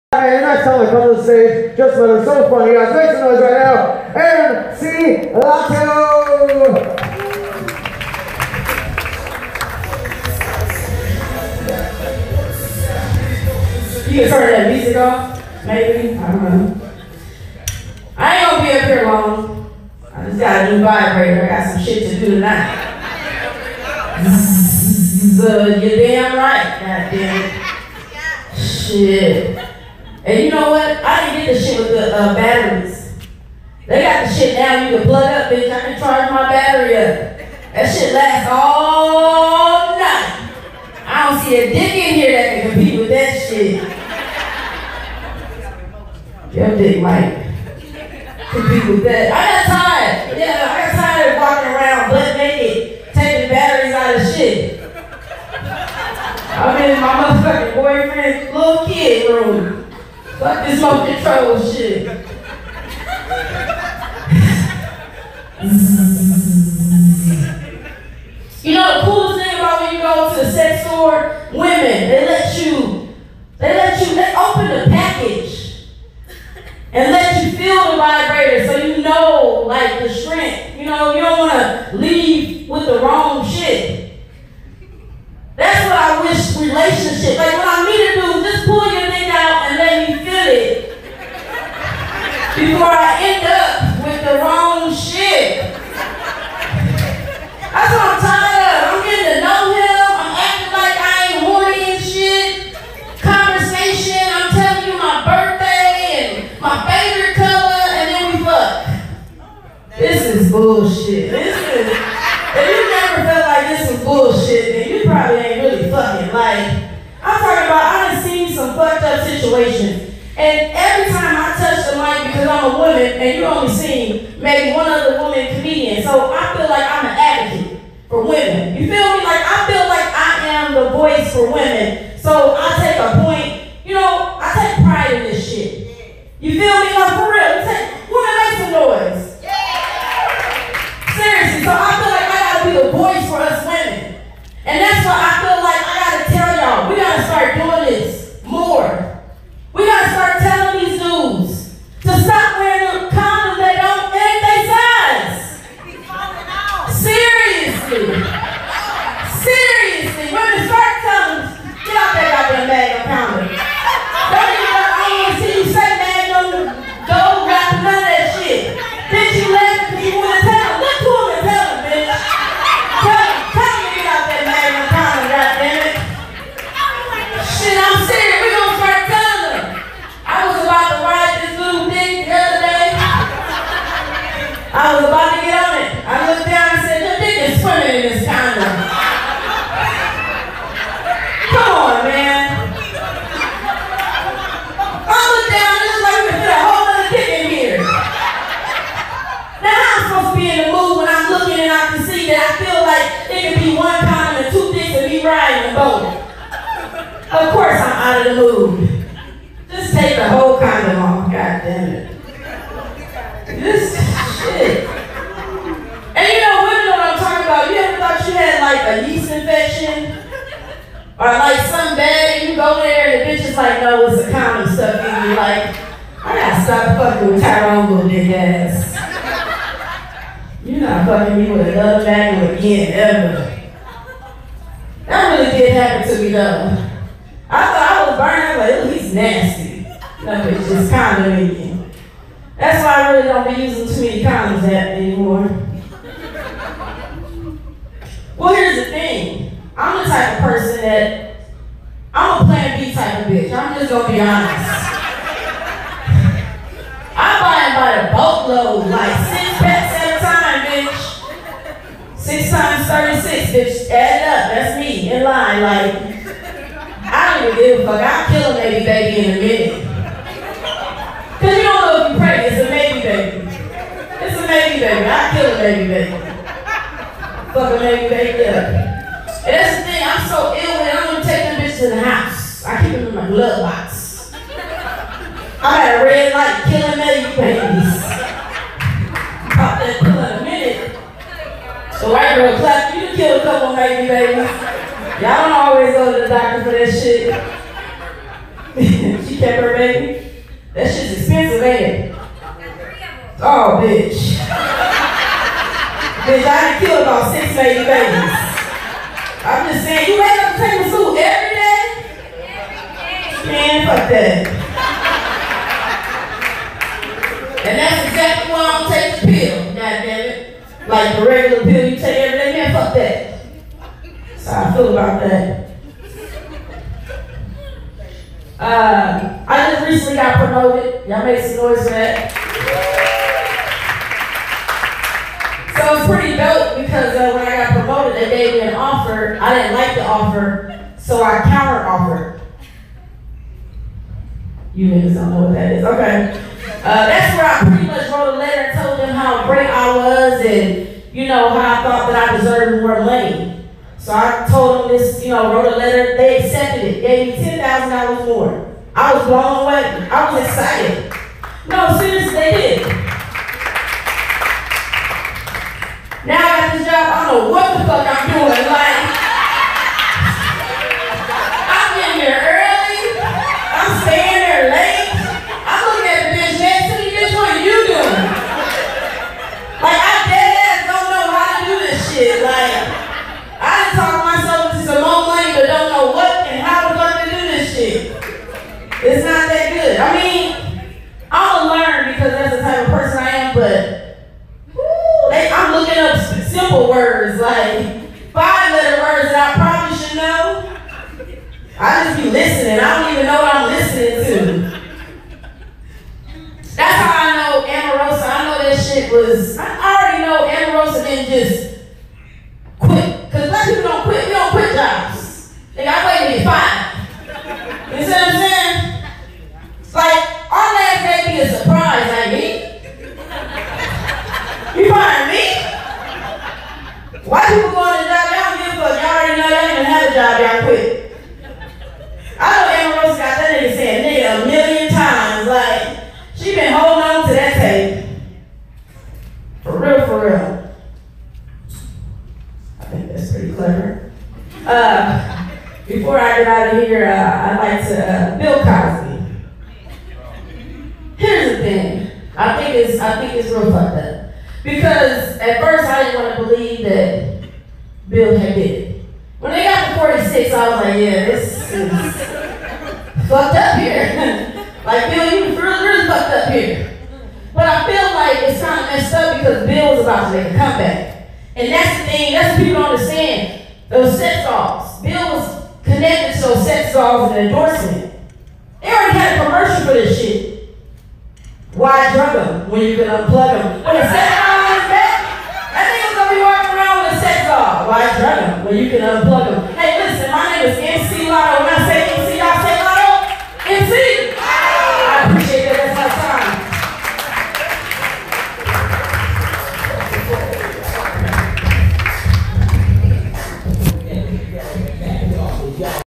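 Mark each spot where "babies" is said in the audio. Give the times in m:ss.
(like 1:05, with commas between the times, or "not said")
4:47, 4:54, 5:07.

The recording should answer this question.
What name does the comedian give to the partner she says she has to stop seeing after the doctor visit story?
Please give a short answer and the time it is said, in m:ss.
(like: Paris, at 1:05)
Tyrone, at 3:47.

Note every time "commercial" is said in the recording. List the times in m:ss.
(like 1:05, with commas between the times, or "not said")
7:59.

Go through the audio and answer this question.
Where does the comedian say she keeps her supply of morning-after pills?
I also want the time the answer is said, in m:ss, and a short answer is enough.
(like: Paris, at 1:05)
glove box, at 4:43.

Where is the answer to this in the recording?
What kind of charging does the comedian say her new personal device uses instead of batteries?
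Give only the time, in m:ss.
0:35.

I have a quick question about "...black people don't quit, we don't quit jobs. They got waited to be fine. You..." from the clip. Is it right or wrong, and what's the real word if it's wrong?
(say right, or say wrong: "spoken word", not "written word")
right.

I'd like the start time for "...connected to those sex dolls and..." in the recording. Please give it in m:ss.
7:55.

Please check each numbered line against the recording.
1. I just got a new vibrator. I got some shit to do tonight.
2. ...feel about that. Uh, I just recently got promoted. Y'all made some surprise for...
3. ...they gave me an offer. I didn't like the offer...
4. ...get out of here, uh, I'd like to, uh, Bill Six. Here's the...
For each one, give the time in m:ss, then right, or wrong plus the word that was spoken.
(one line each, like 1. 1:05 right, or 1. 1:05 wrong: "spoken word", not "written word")
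1. 0:20 right
2. 5:24 wrong: "noise", not "surprise"
3. 5:38 right
4. 7:26 wrong: "Cosby", not "Six".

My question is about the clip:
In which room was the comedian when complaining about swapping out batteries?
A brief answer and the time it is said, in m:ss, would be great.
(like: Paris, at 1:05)
boyfriend's little kid room, at 0:57.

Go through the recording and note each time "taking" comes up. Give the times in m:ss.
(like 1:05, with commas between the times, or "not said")
0:53, 5:18.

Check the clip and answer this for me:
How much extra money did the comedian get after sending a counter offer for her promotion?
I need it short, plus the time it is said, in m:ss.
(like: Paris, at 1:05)
$10,000, at 5:57.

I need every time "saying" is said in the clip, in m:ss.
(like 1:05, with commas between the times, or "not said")
5:09, 6:58.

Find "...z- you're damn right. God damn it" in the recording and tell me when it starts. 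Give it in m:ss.
0:25.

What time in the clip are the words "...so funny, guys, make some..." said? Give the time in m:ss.
0:02.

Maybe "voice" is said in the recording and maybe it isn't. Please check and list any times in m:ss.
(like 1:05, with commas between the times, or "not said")
2:10, 2:22.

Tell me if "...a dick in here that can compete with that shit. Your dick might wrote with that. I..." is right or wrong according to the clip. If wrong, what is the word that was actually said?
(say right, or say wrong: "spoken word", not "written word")
wrong: "compete", not "wrote".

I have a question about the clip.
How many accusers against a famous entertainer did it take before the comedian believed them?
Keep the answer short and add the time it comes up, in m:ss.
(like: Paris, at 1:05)
46, at 7:40.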